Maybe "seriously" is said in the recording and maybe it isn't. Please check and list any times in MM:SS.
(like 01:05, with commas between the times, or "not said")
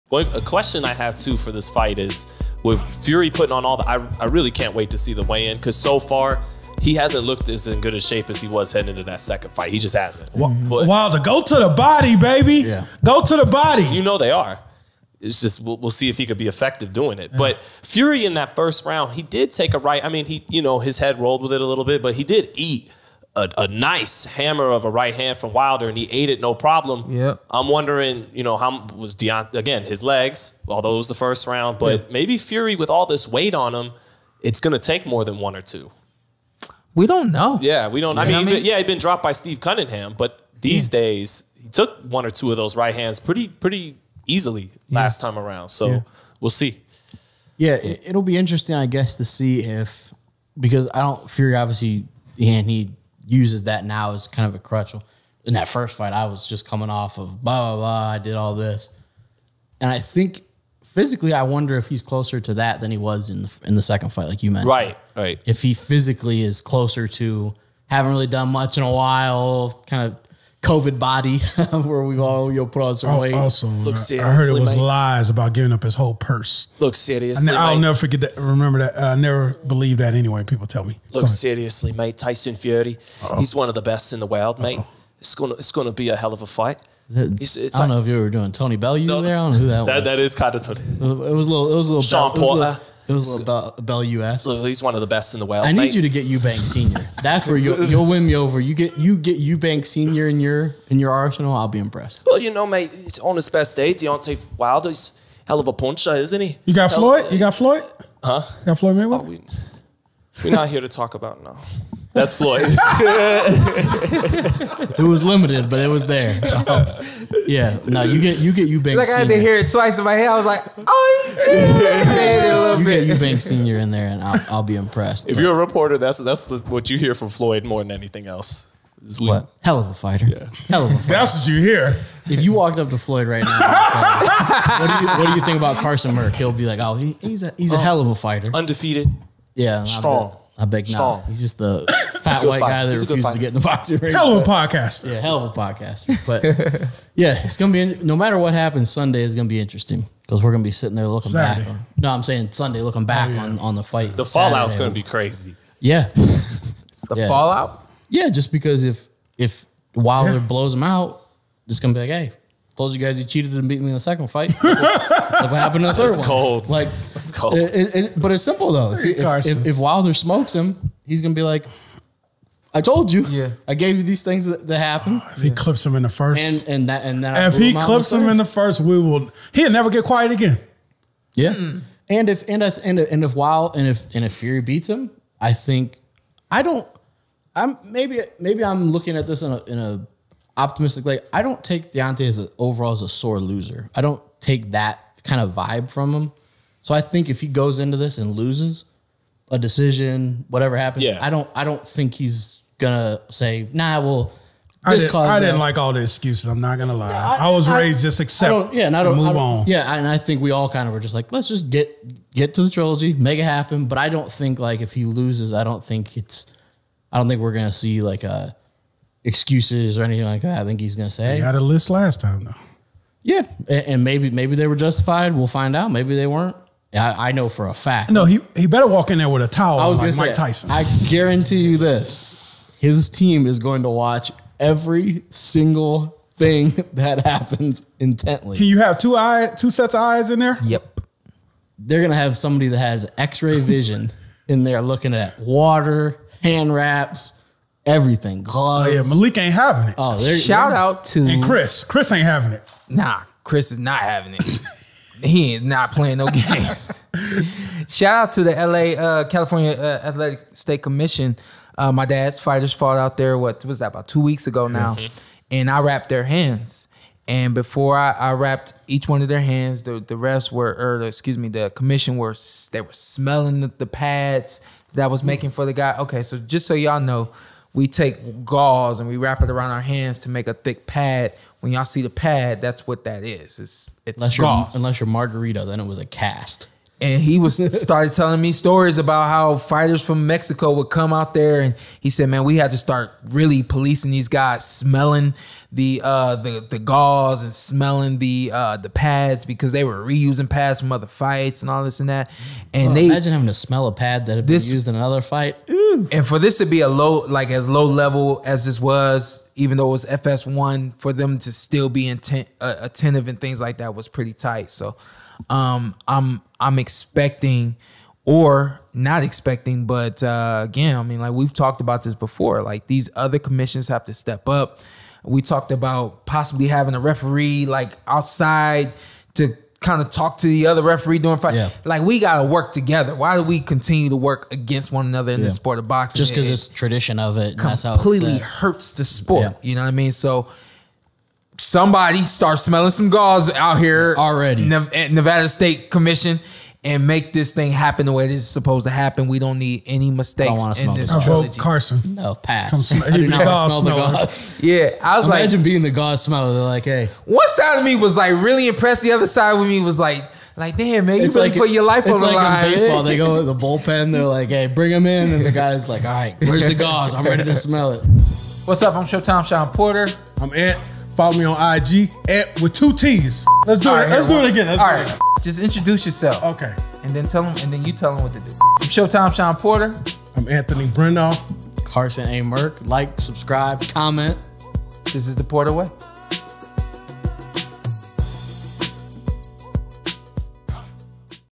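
01:16, 01:21.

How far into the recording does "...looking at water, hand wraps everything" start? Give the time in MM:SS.
04:04.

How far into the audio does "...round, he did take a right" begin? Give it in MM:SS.
00:18.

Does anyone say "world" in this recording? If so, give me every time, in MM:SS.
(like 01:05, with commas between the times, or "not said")
01:24, 01:35.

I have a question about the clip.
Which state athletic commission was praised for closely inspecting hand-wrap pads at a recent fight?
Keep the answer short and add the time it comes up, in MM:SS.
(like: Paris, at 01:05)
California, at 04:19.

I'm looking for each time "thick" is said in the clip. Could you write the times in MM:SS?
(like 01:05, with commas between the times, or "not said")
04:40.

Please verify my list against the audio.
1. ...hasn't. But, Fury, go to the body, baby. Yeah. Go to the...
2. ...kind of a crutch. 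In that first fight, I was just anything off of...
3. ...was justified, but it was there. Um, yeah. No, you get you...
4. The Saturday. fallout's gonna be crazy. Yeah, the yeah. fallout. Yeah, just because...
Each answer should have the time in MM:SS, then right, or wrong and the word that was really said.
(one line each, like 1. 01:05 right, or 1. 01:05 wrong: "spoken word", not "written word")
1. 00:09 wrong: "Wilder", not "Fury"
2. 00:54 wrong: "coming", not "anything"
3. 01:54 wrong: "limited", not "justified"
4. 02:34 right.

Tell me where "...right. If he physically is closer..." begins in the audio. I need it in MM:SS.
01:05.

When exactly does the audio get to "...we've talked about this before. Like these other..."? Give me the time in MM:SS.
05:21.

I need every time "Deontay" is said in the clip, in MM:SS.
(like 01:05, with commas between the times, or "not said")
00:29, 01:43, 03:11.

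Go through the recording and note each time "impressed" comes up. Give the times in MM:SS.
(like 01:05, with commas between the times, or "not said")
01:41, 02:04, 05:58.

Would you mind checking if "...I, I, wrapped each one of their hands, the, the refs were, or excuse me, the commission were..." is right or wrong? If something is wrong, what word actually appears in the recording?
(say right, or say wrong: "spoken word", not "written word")
right.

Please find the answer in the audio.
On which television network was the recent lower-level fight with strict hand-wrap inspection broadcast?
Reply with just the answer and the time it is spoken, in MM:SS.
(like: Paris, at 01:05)
FS1, at 05:10.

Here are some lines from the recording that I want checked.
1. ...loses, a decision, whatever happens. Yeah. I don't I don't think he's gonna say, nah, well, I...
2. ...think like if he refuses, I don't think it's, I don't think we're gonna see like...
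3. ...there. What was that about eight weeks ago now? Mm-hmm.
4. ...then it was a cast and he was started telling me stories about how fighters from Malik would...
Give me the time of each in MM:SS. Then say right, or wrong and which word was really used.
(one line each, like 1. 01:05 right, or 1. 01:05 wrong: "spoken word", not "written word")
1. 03:18 right
2. 03:34 wrong: "loses", not "refuses"
3. 04:23 wrong: "two", not "eight"
4. 04:45 wrong: "Mexico", not "Malik".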